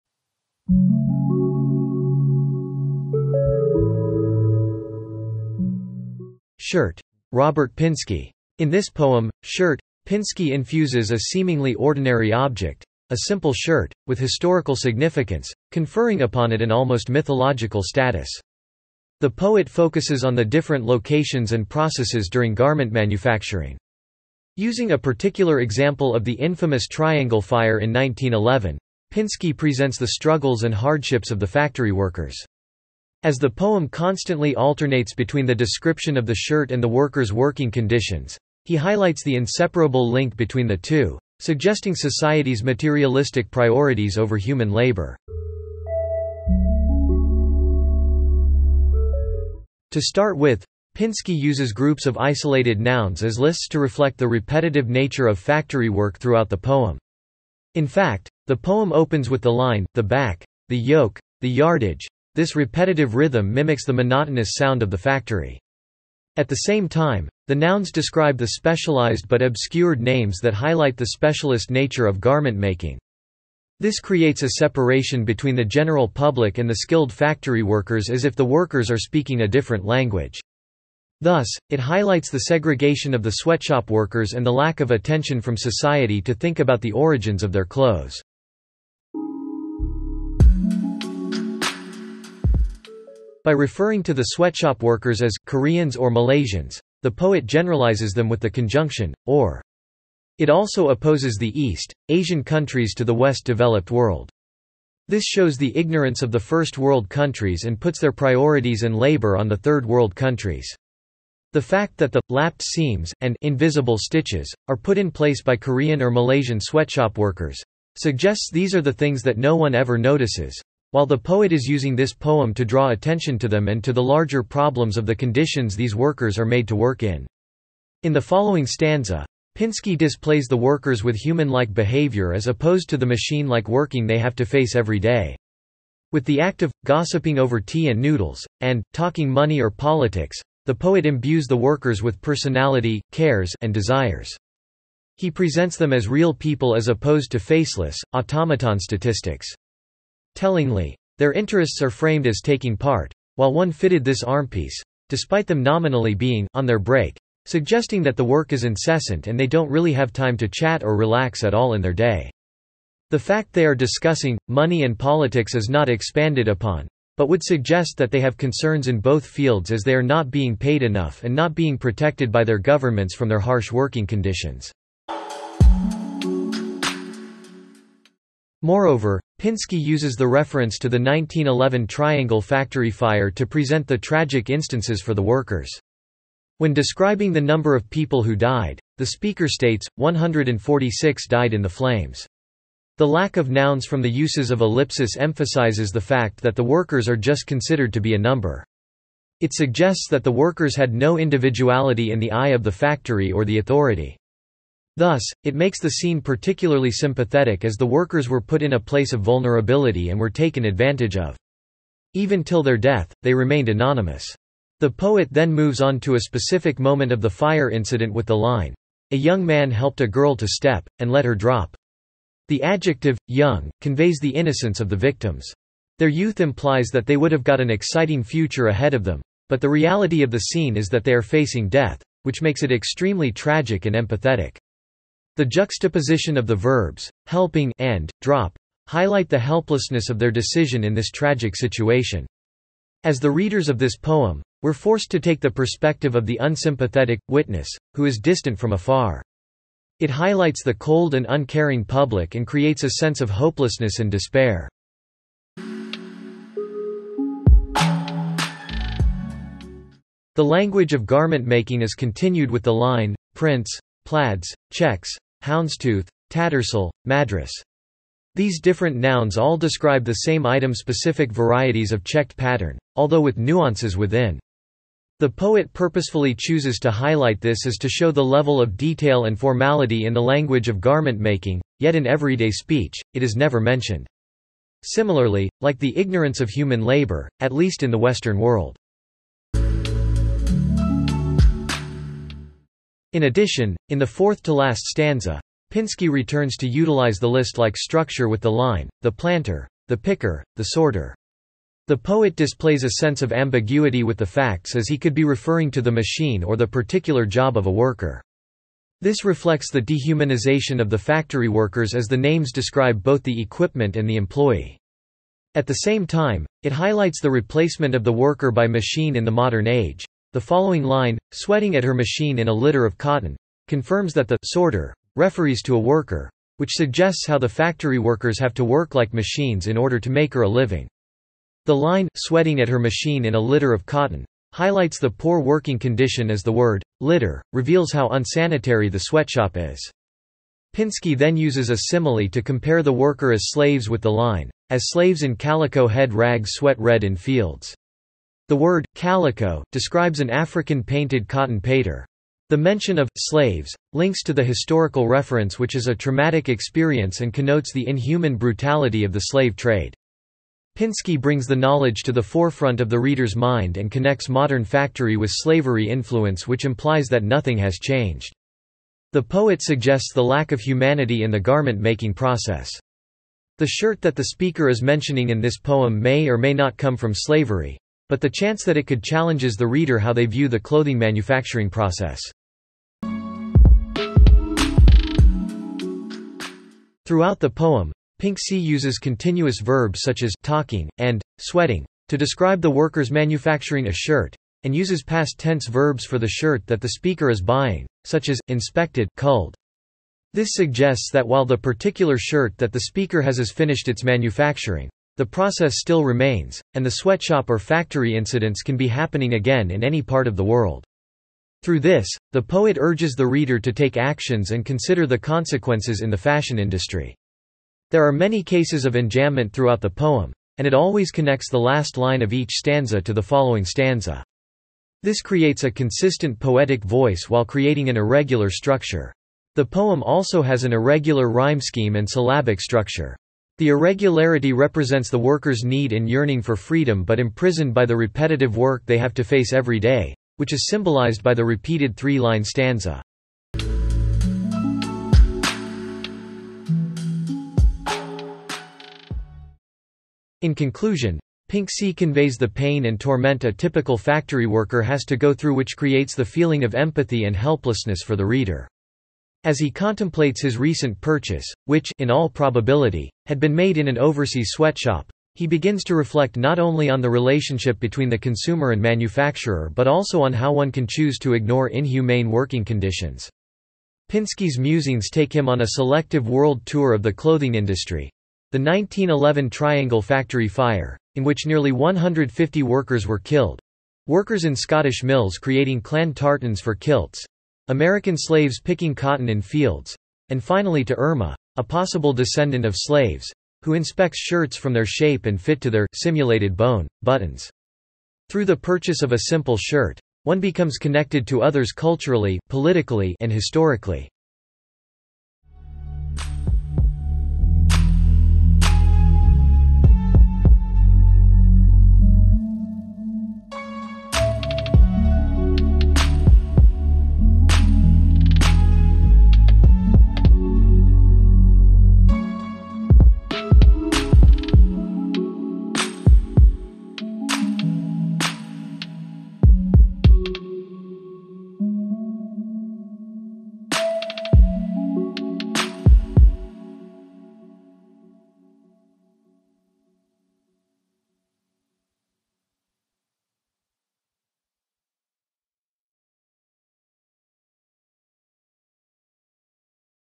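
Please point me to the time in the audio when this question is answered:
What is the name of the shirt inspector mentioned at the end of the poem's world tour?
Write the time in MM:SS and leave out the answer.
08:10.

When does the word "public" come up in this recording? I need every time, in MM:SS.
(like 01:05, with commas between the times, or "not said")
01:16, 04:11.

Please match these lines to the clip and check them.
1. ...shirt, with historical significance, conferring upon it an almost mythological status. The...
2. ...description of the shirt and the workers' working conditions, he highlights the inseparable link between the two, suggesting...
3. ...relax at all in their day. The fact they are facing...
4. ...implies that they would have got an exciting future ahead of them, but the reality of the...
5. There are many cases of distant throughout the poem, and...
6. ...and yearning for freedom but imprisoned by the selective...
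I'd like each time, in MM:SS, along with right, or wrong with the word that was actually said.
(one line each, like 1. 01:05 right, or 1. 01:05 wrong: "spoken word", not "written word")
1. 00:13 right
2. 00:35 right
3. 02:40 wrong: "discussing", not "facing"
4. 03:46 right
5. 06:57 wrong: "enjambment", not "distant"
6. 07:15 wrong: "repetitive", not "selective".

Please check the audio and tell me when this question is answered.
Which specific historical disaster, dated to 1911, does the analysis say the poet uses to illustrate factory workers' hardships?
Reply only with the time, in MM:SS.
00:26.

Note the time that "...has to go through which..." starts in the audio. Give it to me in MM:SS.
07:34.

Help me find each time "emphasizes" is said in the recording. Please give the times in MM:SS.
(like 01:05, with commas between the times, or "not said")
03:15.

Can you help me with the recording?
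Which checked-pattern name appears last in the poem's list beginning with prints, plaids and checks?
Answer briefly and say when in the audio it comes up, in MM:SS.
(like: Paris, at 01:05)
madras, at 04:27.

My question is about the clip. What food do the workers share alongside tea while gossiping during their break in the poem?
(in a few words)
noodles.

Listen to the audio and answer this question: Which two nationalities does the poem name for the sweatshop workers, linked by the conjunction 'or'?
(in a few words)
Korean or Malaysian.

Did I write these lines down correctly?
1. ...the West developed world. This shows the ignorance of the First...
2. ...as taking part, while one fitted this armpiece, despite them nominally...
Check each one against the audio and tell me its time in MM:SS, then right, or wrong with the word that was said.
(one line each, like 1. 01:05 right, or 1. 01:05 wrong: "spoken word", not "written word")
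1. 01:43 right
2. 02:32 right.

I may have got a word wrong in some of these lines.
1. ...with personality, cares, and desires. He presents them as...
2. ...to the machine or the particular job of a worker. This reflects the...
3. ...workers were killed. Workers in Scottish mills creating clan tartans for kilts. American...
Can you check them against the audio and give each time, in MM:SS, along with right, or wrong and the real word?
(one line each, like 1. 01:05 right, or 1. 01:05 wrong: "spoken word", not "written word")
1. 02:22 right
2. 05:05 right
3. 08:02 right.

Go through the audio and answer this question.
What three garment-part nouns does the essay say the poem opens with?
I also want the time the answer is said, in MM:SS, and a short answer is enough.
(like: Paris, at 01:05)
the back, the yoke, the yardage, at 00:59.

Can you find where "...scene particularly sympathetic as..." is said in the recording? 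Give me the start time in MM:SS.
03:25.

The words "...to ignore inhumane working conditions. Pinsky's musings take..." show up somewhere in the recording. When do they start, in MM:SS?
07:51.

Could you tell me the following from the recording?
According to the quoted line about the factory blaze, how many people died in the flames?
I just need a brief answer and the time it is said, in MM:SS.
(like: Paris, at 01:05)
146, at 03:09.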